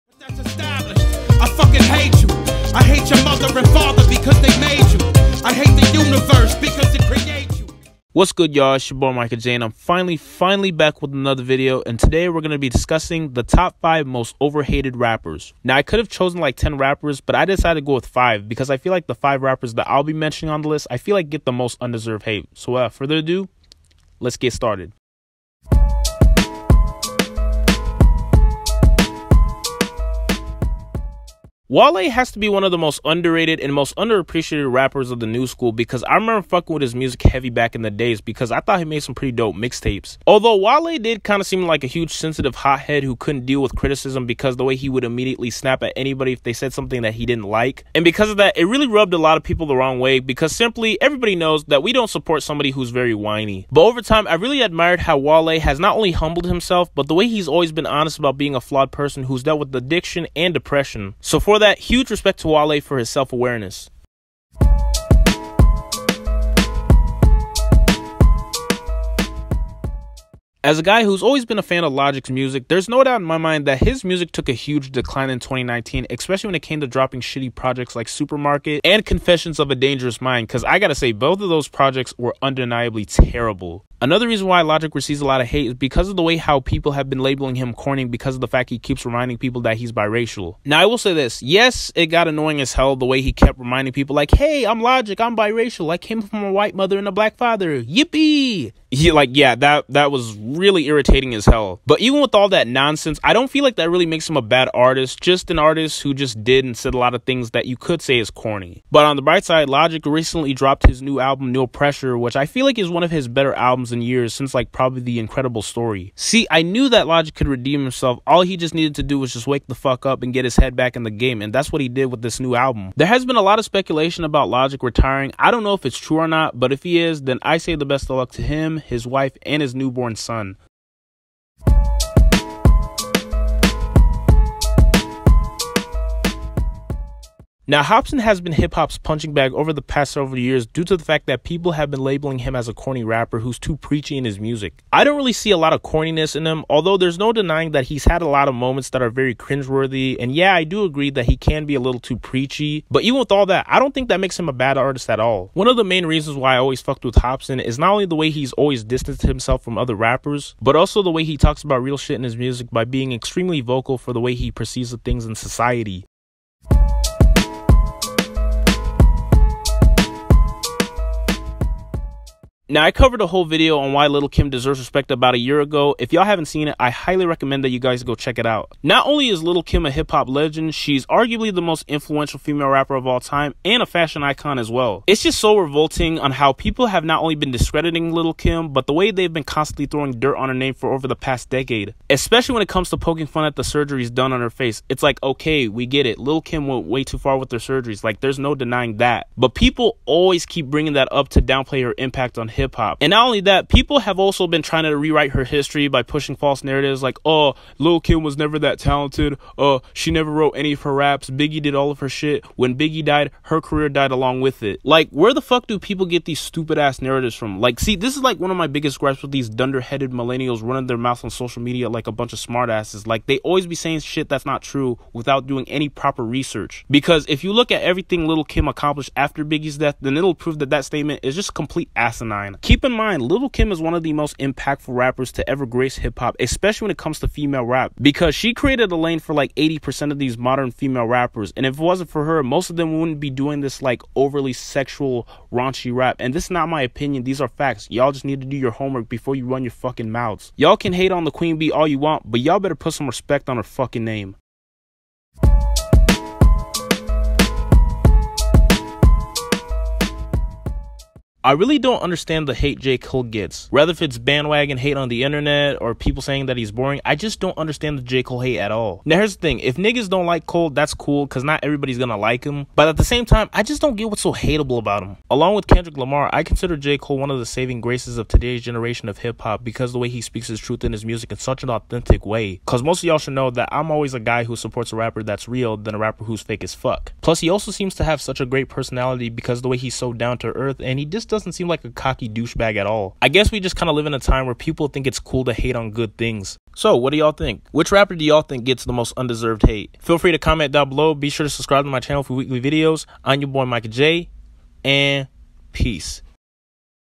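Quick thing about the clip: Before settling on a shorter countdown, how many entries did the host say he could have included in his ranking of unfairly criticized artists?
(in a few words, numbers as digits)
10.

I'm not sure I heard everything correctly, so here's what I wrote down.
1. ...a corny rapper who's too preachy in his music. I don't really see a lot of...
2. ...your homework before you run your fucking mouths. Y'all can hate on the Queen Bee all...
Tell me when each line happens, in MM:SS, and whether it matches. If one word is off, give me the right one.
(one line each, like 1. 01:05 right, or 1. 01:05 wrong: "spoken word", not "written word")
1. 02:22 right
2. 04:08 right.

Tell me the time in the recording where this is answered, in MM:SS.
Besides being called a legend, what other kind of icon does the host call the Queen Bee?
03:03.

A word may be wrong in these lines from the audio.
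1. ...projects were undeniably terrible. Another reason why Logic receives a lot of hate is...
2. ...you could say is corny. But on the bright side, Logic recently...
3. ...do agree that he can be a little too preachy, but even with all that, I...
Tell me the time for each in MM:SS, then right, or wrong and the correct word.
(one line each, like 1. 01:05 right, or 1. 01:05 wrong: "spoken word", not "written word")
1. 01:21 right
2. 01:47 right
3. 02:30 right.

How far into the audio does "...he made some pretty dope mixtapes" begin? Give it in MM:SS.
00:38.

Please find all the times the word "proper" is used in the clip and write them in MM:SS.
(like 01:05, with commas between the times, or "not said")
03:45.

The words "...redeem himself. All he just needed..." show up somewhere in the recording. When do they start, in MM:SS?
01:57.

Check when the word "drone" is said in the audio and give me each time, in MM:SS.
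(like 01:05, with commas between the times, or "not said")
not said.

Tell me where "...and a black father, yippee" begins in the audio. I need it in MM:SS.
01:36.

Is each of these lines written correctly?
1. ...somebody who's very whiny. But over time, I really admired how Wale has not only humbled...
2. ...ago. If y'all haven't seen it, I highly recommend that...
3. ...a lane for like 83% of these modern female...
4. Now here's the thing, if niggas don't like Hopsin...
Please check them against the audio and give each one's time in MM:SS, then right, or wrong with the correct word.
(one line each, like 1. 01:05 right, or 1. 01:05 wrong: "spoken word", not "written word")
1. 00:52 right
2. 02:55 right
3. 03:58 wrong: "80", not "83"
4. 04:29 wrong: "Cole", not "Hopsin".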